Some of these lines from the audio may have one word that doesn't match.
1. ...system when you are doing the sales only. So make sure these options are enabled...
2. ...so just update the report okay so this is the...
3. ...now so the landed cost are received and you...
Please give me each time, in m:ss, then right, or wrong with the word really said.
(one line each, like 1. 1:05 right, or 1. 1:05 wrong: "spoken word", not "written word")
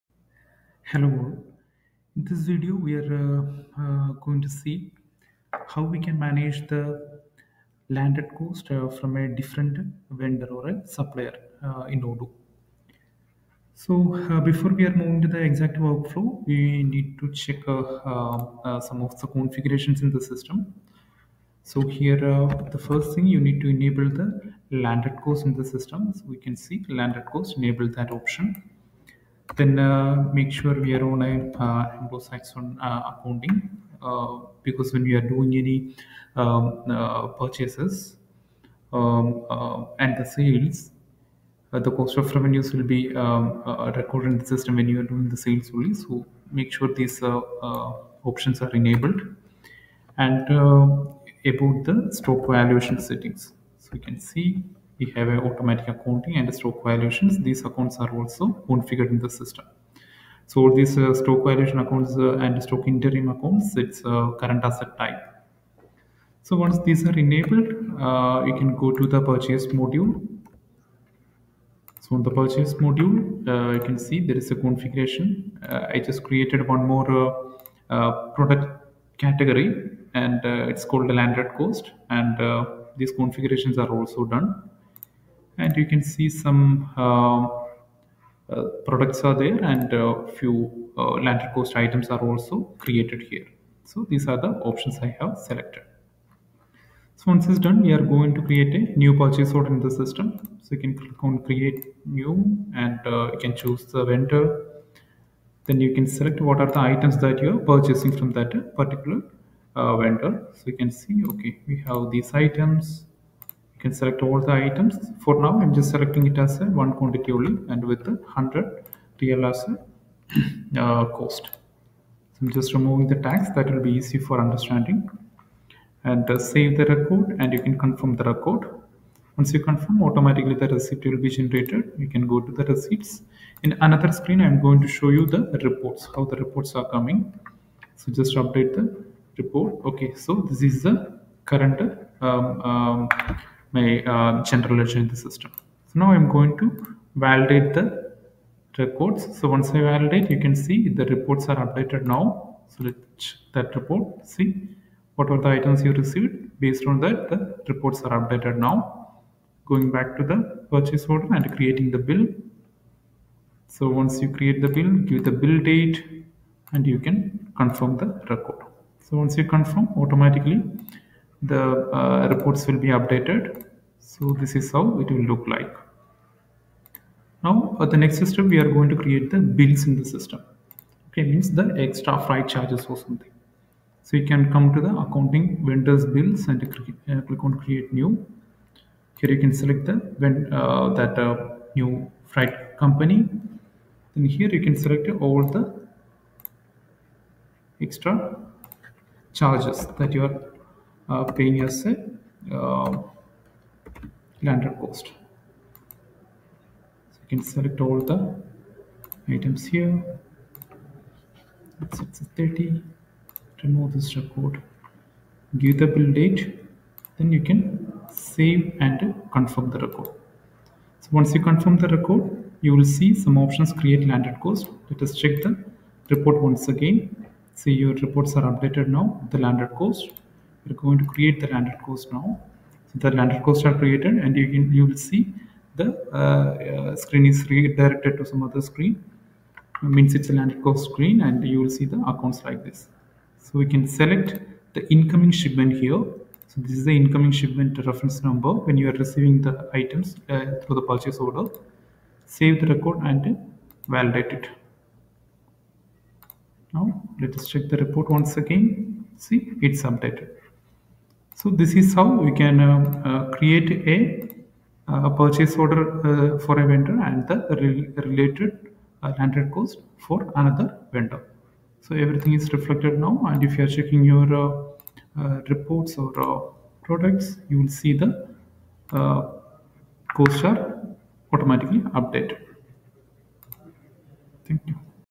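1. 0:44 right
2. 2:18 right
3. 3:52 wrong: "created", not "received".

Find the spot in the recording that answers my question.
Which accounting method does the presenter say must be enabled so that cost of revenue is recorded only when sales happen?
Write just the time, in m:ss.
0:32.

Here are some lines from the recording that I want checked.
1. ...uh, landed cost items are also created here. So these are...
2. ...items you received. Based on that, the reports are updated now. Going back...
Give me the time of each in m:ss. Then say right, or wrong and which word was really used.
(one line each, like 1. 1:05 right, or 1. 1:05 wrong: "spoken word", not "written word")
1. 1:30 right
2. 2:35 right.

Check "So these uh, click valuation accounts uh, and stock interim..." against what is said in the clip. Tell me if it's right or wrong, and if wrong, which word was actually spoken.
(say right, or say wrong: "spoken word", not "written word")
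wrong: "stock", not "click".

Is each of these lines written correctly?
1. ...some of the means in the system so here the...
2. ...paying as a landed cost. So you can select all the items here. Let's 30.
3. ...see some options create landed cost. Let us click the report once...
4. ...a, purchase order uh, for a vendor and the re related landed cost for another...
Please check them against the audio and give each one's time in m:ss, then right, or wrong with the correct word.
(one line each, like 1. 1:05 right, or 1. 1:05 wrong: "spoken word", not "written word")
1. 0:18 wrong: "configurations", not "means"
2. 3:21 right
3. 3:42 wrong: "check", not "click"
4. 4:24 right.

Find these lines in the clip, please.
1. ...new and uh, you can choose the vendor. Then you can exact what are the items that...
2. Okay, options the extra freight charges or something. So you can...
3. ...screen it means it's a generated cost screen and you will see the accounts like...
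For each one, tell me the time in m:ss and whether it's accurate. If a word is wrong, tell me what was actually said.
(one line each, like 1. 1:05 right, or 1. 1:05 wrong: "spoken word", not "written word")
1. 1:42 wrong: "select", not "exact"
2. 3:01 wrong: "means", not "options"
3. 3:58 wrong: "landed", not "generated".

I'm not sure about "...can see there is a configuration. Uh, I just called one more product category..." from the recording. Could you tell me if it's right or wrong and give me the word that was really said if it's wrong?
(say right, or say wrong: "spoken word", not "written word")
wrong: "created", not "called".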